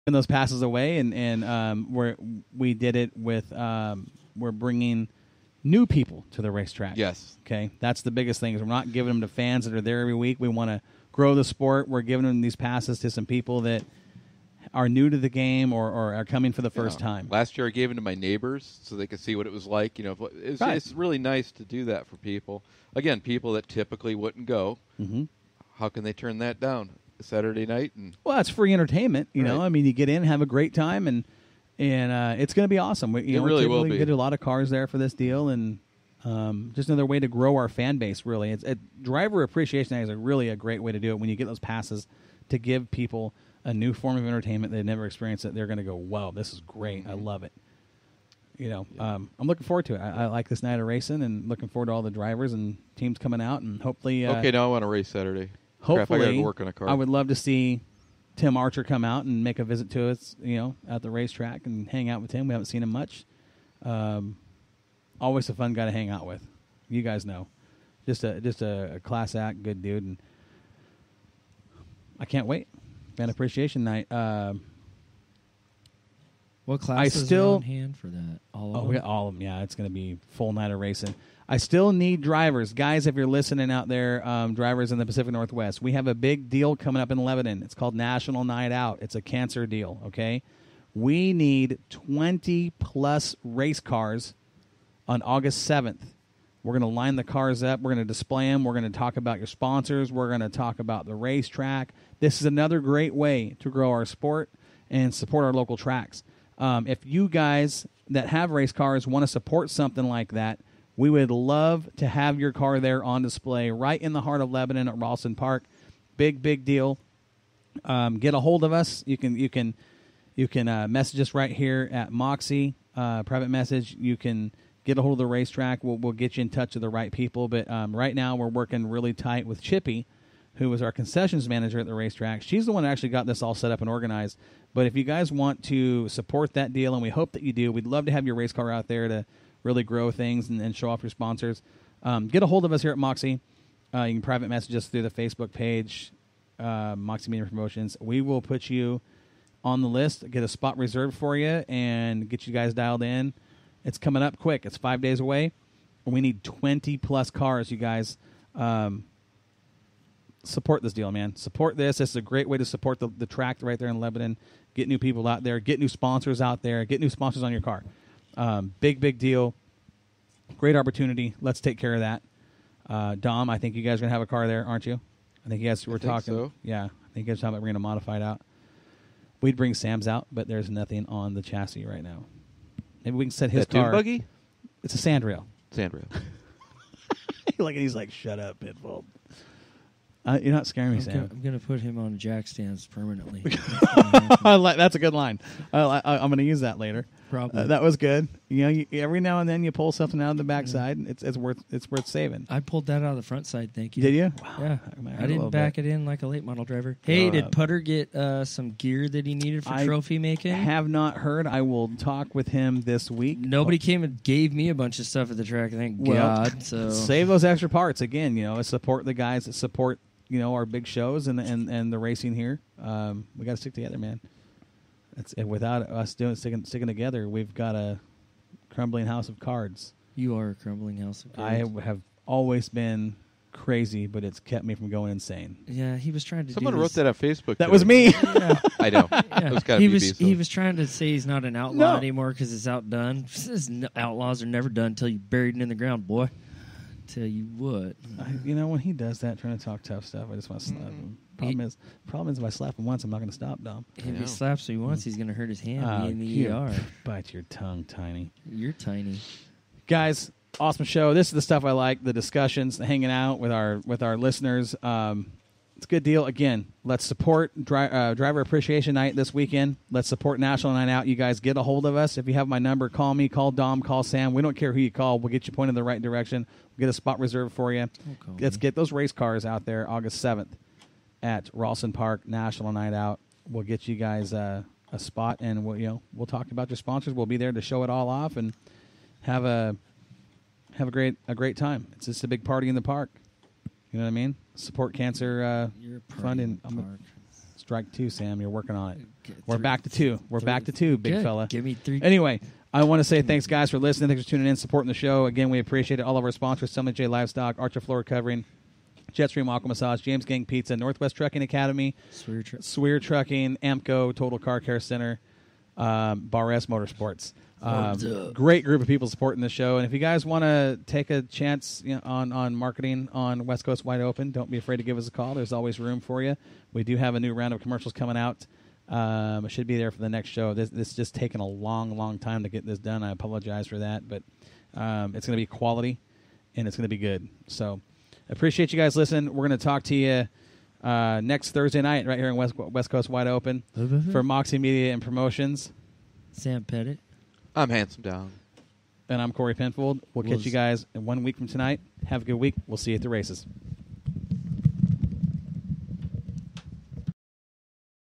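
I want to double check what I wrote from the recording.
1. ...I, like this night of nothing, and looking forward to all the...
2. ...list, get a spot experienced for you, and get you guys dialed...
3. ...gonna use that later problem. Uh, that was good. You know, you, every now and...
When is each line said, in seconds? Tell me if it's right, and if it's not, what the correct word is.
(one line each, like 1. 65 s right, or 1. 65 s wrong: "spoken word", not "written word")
1. 50 s wrong: "racing", not "nothing"
2. 149 s wrong: "reserved", not "experienced"
3. 196 s right.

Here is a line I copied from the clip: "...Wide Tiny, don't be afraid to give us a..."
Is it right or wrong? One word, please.
wrong.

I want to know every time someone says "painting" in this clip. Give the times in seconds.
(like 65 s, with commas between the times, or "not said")
not said.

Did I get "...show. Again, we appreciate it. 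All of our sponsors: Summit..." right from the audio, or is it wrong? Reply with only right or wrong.
right.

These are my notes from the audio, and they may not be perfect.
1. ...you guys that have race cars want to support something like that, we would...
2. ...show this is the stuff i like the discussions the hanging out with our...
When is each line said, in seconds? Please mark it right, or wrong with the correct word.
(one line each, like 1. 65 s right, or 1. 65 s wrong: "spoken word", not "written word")
1. 107 s right
2. 260 s right.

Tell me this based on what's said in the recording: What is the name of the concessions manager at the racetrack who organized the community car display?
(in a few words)
Chippy.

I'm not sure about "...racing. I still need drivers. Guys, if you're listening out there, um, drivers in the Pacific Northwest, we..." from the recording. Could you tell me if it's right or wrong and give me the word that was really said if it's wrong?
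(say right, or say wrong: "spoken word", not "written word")
right.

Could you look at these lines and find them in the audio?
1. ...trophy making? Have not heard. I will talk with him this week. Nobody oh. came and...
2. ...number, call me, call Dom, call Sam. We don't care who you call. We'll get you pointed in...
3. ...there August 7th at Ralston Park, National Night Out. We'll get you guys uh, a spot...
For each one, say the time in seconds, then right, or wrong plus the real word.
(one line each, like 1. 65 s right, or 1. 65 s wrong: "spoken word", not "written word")
1. 209 s right
2. 272 s right
3. 279 s right.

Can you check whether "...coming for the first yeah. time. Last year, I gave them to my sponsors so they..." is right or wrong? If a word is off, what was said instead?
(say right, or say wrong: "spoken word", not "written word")
wrong: "neighbors", not "sponsors".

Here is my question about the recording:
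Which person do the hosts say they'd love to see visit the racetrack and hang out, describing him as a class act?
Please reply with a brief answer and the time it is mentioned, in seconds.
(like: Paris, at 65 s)
Tim Archer, at 58 s.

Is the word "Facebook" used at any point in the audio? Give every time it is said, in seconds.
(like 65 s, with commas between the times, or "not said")
145 s, 237 s.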